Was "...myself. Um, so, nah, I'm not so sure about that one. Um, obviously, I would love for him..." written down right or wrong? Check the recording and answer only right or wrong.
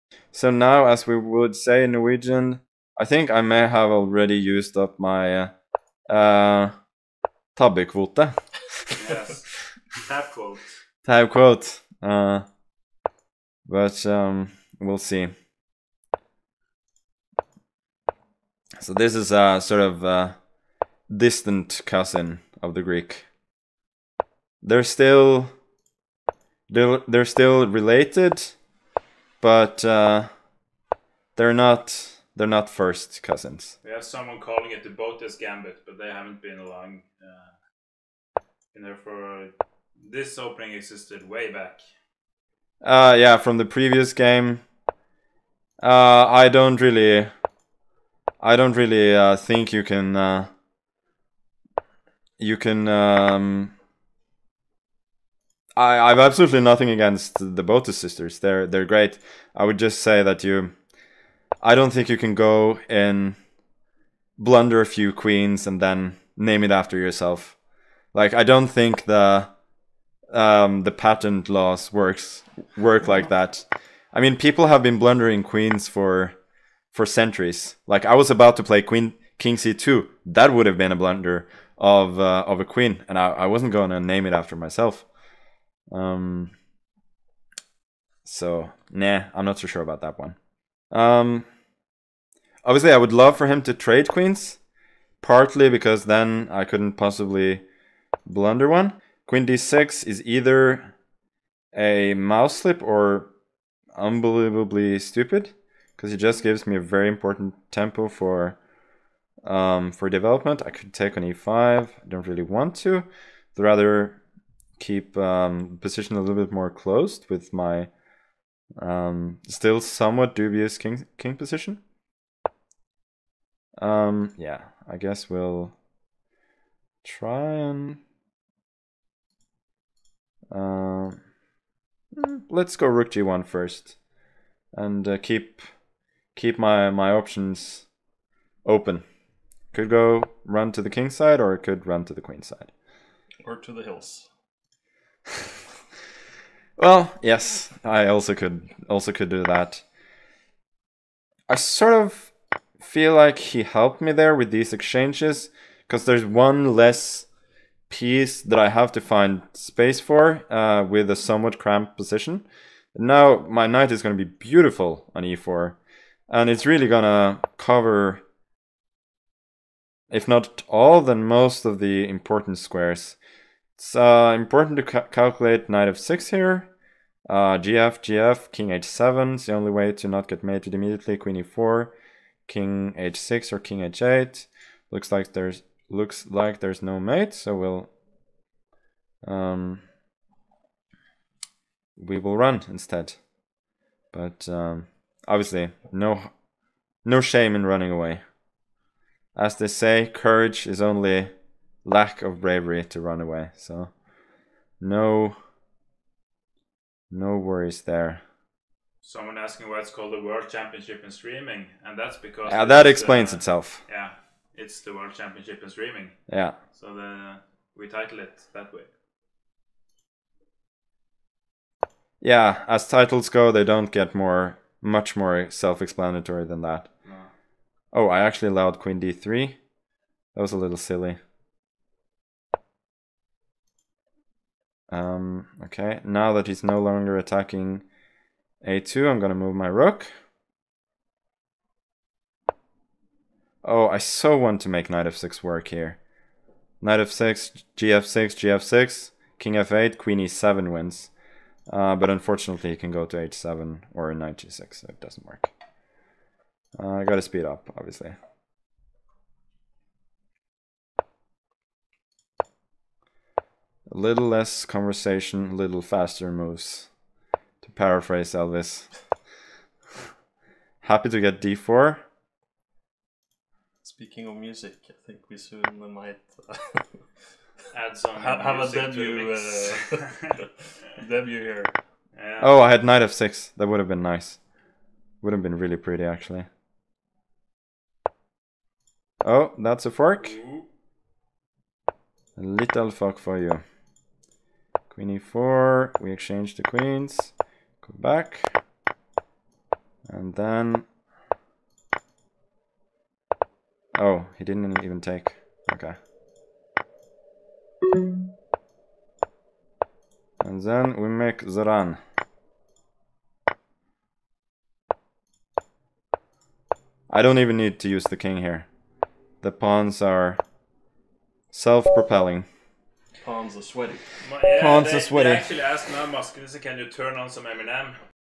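right.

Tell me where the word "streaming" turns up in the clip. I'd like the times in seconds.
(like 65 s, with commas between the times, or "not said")
211 s, 215 s.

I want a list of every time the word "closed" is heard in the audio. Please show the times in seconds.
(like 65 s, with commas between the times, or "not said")
116 s.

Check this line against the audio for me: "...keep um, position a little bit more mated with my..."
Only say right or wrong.
wrong.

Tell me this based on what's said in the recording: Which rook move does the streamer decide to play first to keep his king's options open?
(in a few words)
Rook g1.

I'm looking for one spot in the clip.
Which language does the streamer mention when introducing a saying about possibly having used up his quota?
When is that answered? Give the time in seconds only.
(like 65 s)
1 s.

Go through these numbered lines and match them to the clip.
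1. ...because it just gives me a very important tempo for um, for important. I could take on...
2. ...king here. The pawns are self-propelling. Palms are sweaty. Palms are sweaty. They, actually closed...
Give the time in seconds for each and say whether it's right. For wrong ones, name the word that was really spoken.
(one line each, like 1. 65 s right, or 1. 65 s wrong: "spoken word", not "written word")
1. 105 s wrong: "development", not "important"
2. 318 s wrong: "asked", not "closed".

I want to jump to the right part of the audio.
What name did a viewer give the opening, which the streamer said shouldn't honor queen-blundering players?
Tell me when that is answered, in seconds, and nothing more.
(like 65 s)
34 s.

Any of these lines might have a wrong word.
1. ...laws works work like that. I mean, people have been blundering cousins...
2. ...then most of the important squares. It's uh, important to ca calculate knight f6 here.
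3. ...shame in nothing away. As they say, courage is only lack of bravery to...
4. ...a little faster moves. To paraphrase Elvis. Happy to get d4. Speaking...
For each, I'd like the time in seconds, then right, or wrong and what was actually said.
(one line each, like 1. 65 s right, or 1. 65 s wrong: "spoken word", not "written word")
1. 71 s wrong: "queens", not "cousins"
2. 170 s right
3. 197 s wrong: "running", not "nothing"
4. 265 s right.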